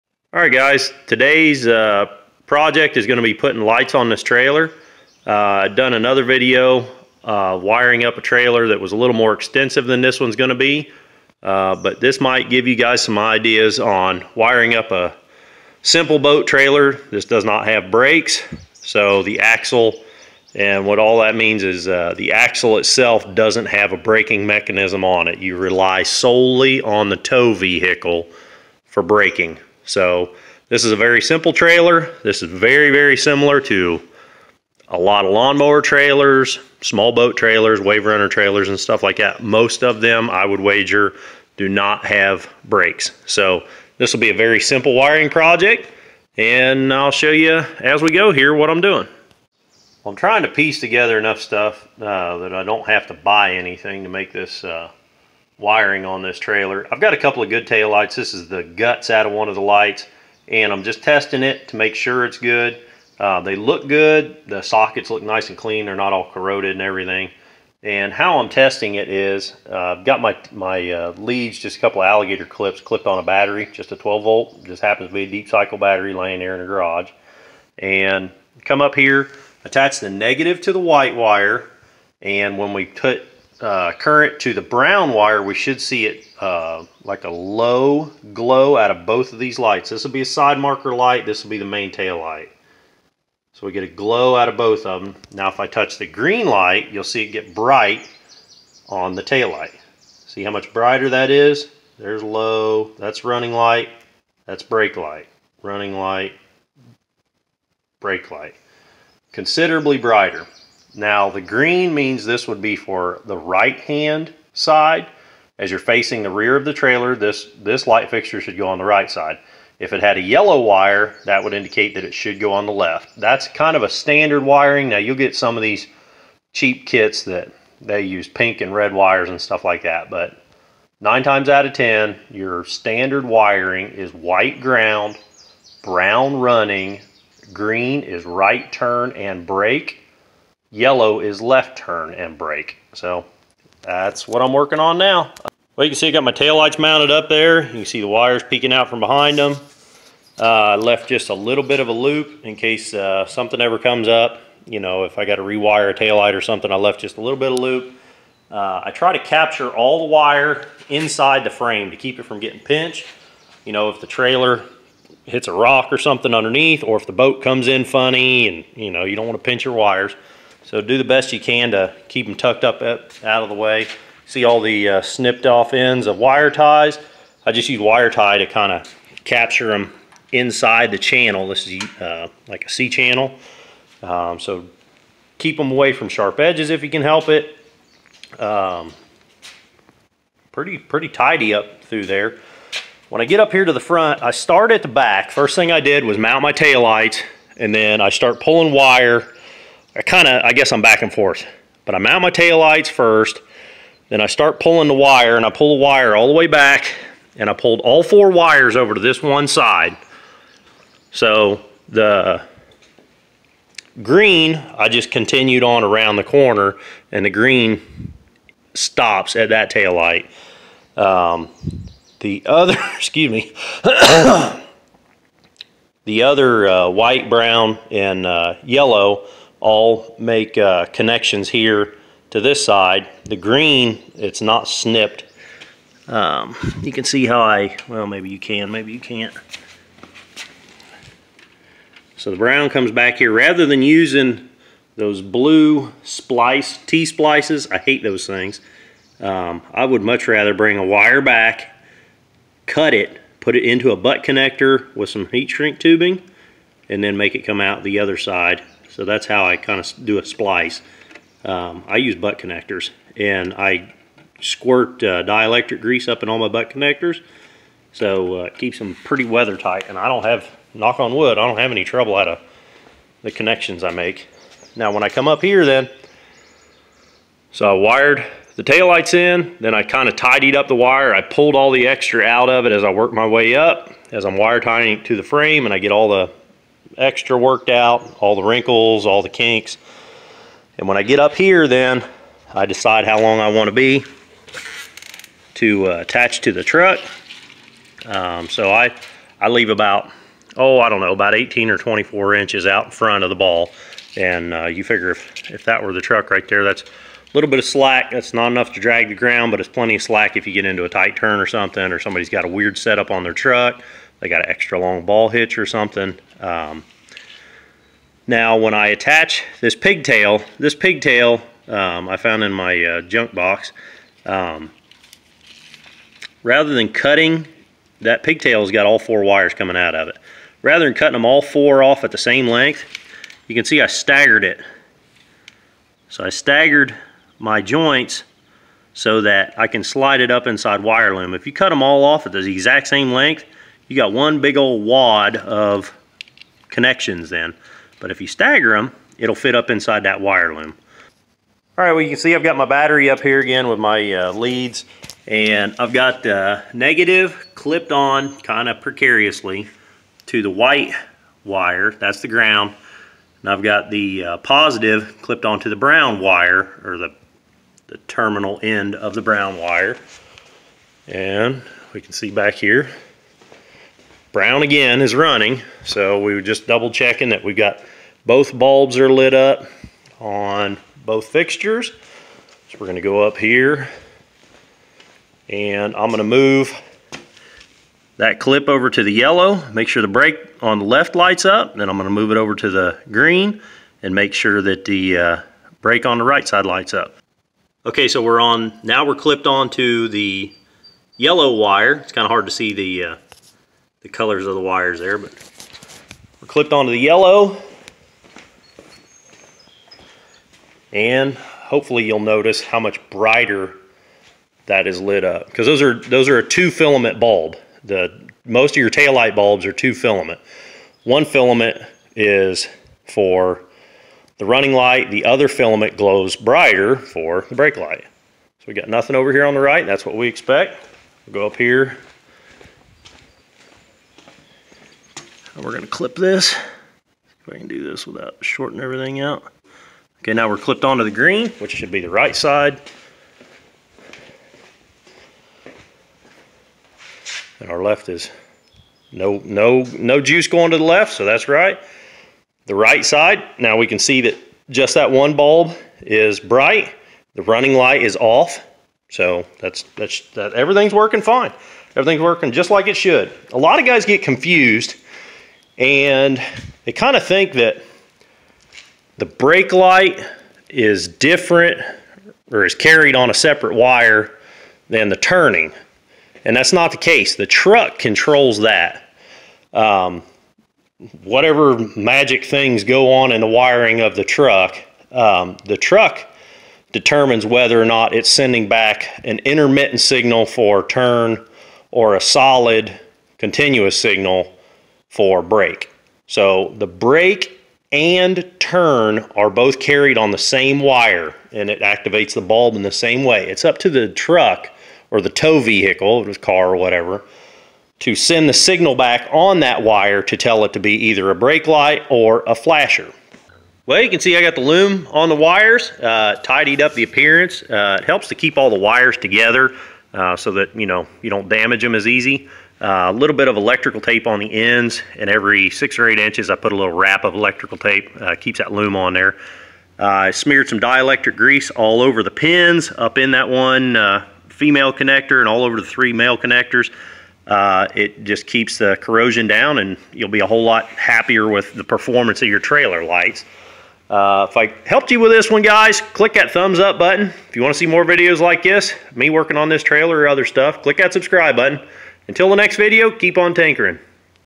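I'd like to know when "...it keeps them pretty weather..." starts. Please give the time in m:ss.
4:28.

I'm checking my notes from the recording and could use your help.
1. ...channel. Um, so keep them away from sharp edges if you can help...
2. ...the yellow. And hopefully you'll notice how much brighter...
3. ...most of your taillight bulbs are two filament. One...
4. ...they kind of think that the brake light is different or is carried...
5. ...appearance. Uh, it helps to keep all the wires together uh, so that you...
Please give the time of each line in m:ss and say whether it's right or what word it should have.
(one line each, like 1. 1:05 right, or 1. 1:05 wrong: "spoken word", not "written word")
1. 3:02 right
2. 6:46 right
3. 6:58 right
4. 7:46 right
5. 8:37 right.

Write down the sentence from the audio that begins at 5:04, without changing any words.
And uh, you figure if, if that were the truck right there, that's a little bit of slack.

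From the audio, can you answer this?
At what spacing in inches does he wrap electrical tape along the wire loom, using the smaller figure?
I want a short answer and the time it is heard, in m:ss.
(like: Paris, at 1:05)
6, at 8:45.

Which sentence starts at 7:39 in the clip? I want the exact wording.
So that's, that's that everything's working fine.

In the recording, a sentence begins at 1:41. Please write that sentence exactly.
There's low, that's running light, that's brake light.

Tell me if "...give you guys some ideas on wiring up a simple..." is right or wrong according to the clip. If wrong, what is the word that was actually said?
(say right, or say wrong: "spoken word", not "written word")
right.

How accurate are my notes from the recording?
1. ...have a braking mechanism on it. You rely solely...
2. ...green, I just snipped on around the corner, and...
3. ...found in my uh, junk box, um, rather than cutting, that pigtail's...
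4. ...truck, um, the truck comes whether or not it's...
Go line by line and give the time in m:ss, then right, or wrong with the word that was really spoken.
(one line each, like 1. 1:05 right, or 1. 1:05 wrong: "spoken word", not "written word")
1. 0:23 right
2. 3:34 wrong: "continued", not "snipped"
3. 5:22 right
4. 8:04 wrong: "determines", not "comes".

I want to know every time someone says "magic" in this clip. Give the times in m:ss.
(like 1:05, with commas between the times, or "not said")
8:01.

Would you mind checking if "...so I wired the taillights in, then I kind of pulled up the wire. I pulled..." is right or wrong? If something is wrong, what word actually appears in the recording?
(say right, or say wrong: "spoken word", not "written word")
wrong: "tidied", not "pulled".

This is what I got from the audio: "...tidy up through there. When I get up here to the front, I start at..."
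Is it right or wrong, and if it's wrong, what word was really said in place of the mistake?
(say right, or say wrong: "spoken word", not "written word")
right.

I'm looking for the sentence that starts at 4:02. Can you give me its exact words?
So the brown comes back here.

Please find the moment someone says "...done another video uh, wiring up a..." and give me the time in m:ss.
0:05.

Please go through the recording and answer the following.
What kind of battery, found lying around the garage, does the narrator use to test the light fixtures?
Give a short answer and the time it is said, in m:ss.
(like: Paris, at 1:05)
Deep cycle battery, at 1:15.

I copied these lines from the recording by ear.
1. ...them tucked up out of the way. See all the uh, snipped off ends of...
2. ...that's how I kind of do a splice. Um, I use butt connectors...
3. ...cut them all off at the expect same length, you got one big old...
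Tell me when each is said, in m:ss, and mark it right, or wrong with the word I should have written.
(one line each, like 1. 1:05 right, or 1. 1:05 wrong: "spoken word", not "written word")
1. 2:52 right
2. 4:19 right
3. 5:41 wrong: "exact", not "expect".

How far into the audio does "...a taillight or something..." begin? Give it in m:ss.
2:35.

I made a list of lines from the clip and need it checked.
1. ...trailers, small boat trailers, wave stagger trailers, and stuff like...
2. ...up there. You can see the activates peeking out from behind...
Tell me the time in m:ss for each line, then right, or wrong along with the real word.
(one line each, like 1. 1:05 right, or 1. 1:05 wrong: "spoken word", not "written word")
1. 0:35 wrong: "runner", not "stagger"
2. 2:27 wrong: "wires", not "activates".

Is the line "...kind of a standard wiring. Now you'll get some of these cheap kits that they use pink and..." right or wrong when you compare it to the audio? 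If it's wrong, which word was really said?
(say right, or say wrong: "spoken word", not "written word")
right.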